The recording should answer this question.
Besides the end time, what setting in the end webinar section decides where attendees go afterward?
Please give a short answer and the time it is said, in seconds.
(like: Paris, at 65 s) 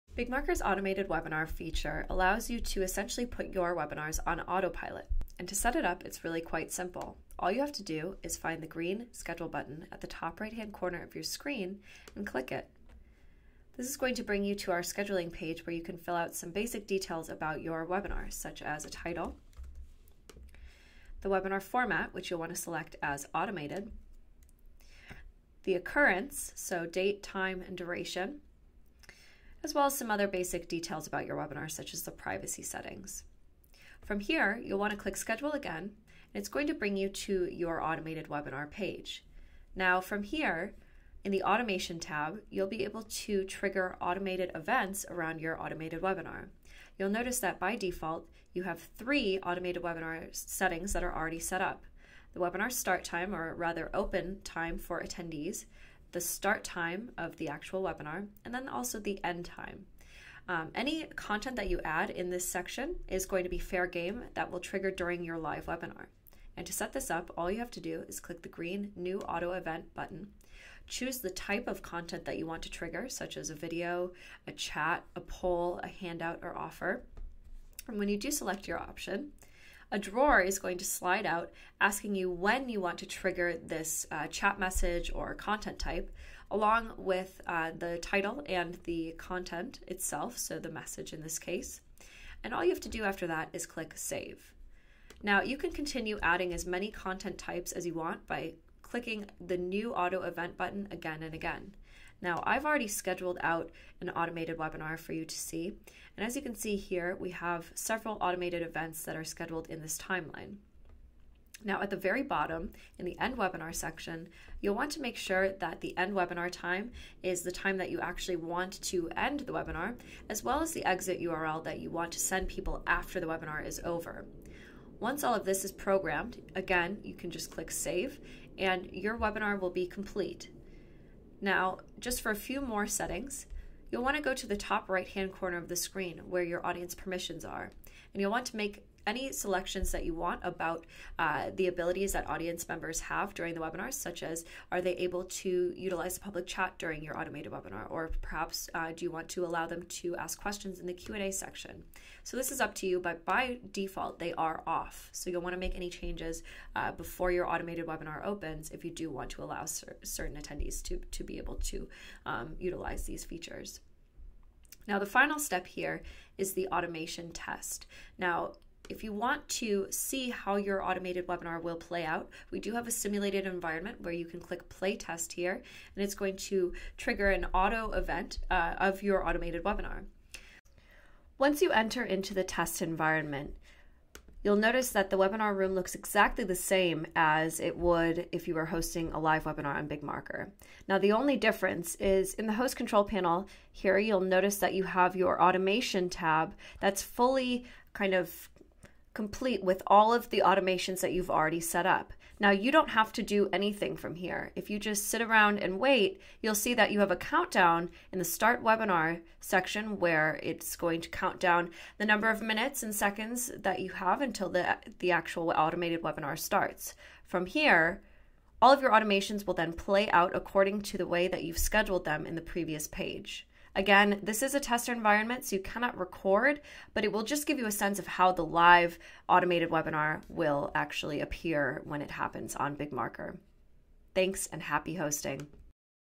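Exit URL, at 120 s.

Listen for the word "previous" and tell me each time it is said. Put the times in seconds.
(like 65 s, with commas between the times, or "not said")
222 s.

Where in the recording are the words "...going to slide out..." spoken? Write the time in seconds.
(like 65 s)
80 s.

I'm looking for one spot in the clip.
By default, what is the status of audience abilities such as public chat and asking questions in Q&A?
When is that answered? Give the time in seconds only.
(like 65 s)
154 s.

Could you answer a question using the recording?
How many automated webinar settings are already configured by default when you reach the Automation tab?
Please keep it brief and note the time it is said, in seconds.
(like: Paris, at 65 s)
3, at 48 s.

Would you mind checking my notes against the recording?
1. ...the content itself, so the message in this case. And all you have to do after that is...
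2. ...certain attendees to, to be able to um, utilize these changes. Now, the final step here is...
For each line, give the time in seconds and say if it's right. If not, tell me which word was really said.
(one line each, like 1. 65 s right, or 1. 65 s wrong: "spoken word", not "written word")
1. 88 s right
2. 160 s wrong: "features", not "changes".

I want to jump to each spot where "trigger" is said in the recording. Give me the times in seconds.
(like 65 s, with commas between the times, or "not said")
43 s, 64 s, 72 s, 83 s, 176 s.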